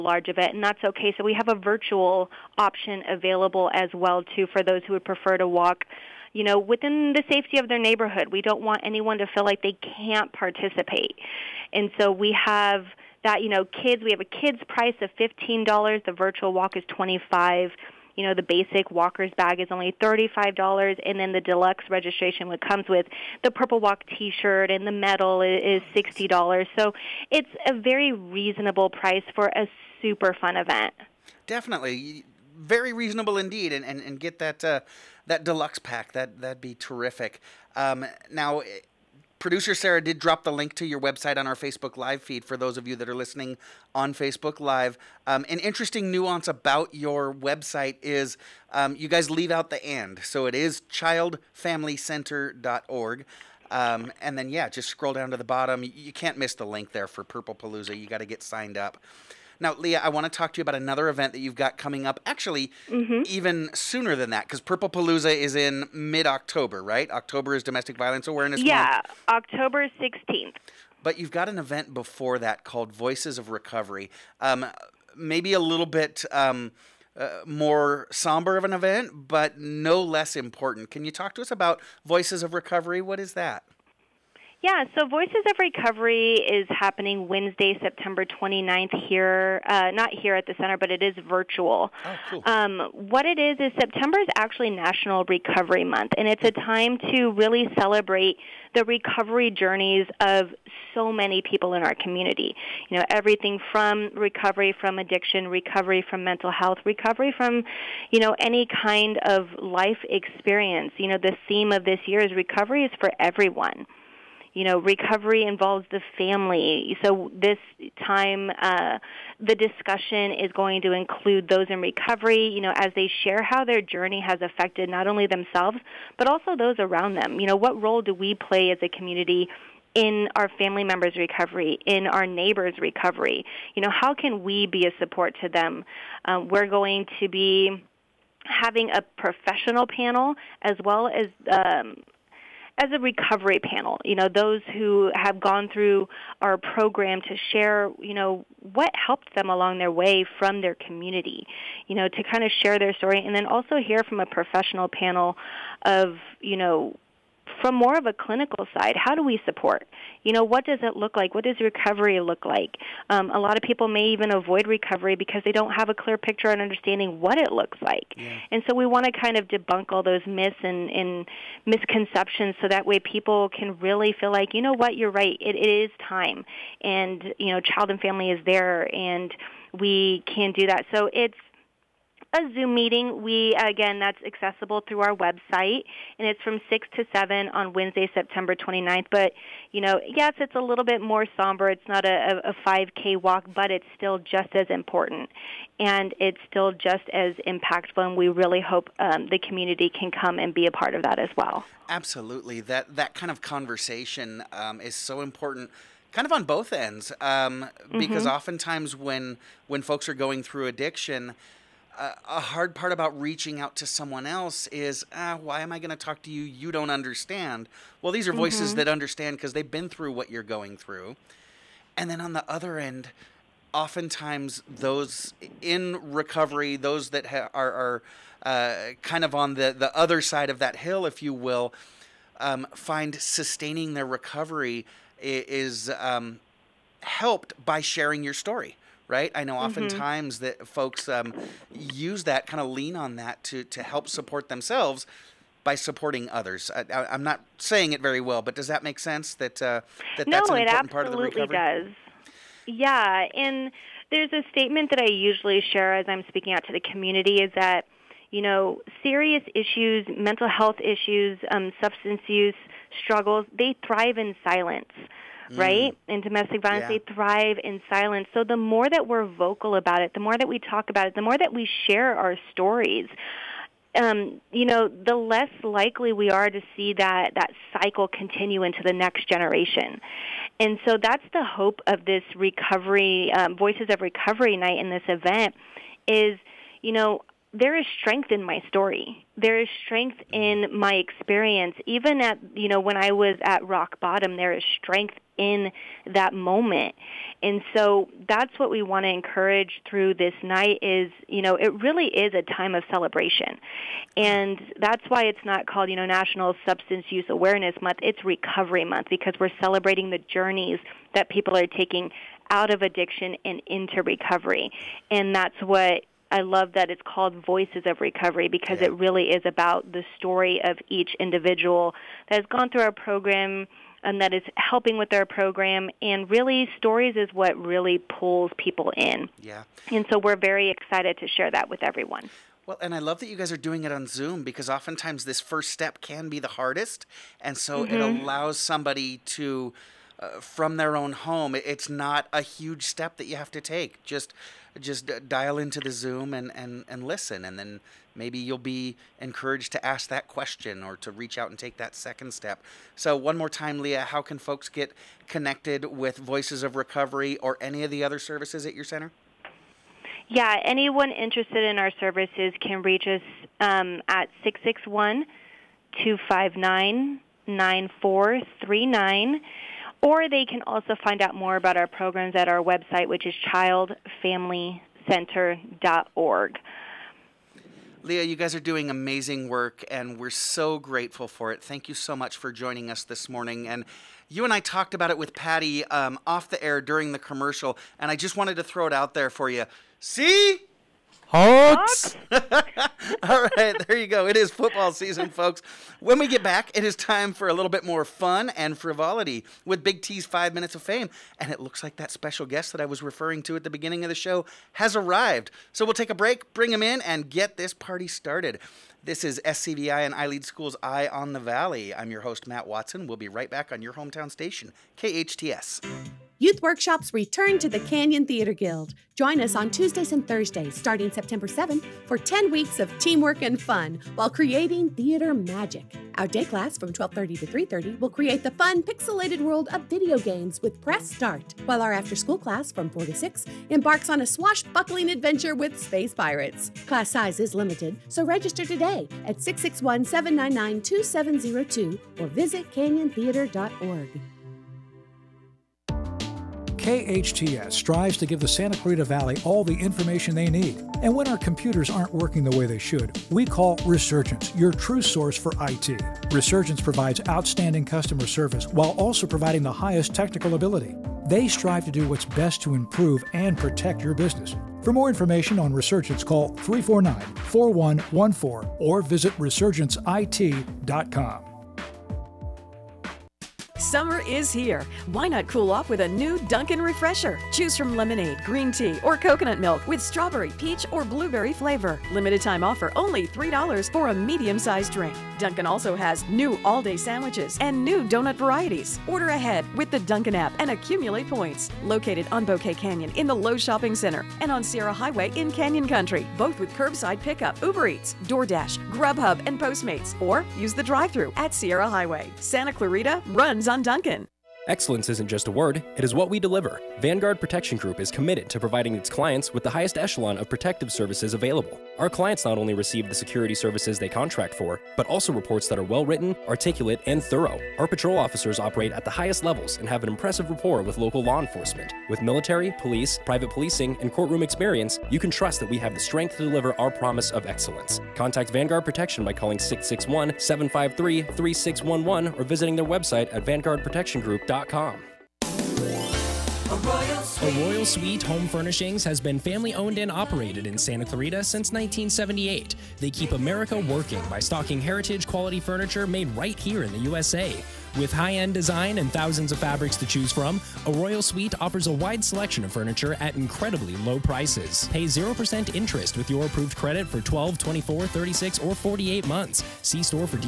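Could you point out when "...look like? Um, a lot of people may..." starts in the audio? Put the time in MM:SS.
02:42.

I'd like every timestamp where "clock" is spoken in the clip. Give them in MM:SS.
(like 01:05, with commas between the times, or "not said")
not said.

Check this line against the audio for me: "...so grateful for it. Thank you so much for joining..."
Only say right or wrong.
right.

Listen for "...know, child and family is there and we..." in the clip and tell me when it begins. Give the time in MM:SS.
02:57.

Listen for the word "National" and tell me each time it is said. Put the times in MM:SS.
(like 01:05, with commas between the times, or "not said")
01:34, 05:06.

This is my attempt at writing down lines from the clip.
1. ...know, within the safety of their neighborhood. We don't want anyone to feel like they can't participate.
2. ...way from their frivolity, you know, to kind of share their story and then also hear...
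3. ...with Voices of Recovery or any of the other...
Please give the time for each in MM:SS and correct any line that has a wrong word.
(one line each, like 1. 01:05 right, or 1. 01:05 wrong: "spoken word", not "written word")
1. 00:06 right
2. 02:29 wrong: "community", not "frivolity"
3. 05:55 right.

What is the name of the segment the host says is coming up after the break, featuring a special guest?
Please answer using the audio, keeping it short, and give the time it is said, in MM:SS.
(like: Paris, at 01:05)
Big T's Five Minutes of Fame, at 06:39.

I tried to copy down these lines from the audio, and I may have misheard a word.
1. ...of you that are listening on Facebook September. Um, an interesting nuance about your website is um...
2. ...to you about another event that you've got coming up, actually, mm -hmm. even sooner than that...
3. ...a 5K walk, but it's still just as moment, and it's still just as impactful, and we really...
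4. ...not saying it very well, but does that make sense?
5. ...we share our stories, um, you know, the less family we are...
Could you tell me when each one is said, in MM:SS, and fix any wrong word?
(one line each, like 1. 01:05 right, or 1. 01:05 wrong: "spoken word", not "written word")
1. 00:42 wrong: "Live", not "September"
2. 01:00 right
3. 03:12 wrong: "important", not "moment"
4. 04:07 right
5. 04:31 wrong: "likely", not "family".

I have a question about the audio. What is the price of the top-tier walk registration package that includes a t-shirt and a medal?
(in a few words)
$60.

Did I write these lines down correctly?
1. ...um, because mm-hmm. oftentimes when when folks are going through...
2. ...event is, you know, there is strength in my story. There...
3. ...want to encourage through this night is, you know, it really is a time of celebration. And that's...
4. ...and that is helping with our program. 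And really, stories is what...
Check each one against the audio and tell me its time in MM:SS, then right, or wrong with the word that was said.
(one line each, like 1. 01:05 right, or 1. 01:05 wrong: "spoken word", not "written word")
1. 03:27 right
2. 04:45 right
3. 04:58 right
4. 05:24 right.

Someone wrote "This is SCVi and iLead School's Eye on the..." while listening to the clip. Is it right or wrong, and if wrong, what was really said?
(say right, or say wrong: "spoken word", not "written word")
right.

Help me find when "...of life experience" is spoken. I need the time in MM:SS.
01:49.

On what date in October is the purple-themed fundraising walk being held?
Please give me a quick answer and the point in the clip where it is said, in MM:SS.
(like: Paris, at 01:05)
October 16th, at 01:09.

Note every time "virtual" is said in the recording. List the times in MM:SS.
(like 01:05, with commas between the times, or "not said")
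00:01, 00:16, 01:31.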